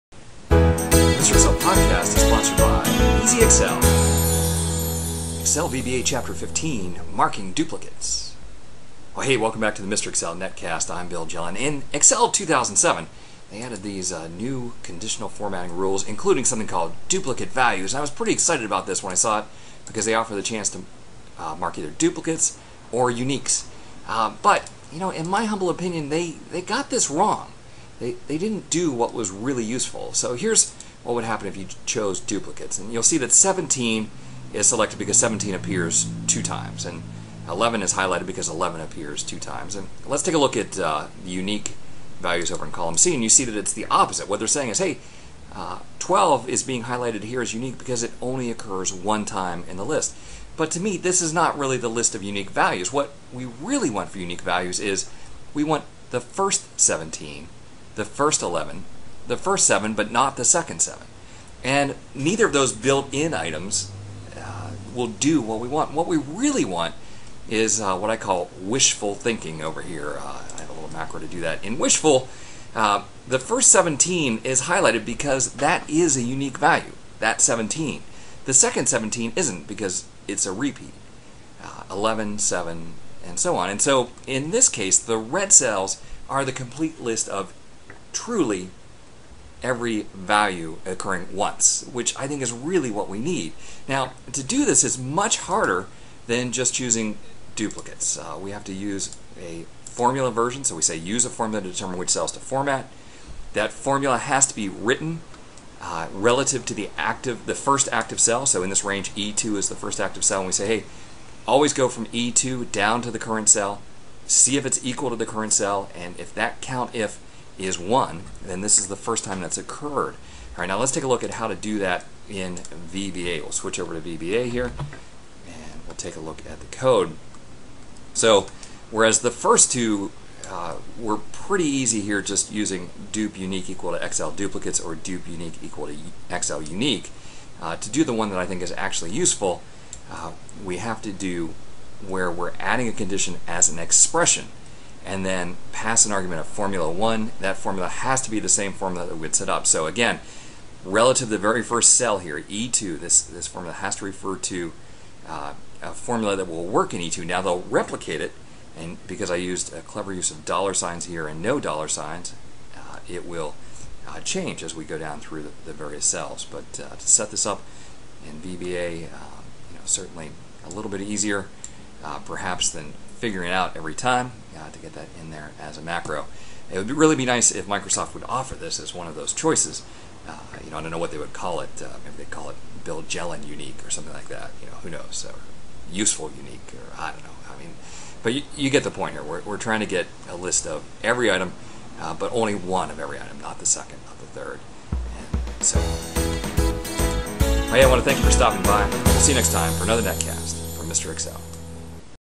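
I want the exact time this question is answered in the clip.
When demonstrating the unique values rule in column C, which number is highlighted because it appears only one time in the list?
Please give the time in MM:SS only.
00:45.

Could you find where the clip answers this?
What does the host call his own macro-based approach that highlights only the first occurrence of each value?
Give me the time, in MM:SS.
01:08.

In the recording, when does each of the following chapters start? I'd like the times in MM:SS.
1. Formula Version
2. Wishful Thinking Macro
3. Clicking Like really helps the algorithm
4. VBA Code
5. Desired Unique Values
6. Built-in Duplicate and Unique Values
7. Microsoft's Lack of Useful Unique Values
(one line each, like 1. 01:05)
1. 01:04
2. 00:37
3. 03:11
4. 01:37
5. 00:27
6. 00:17
7. 02:56.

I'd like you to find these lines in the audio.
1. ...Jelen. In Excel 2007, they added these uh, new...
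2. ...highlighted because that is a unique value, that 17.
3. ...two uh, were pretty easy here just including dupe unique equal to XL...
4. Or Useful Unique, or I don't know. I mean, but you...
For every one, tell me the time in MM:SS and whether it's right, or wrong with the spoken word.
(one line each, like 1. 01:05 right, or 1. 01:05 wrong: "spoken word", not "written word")
1. 00:11 right
2. 01:14 right
3. 02:09 wrong: "using", not "including"
4. 03:05 right.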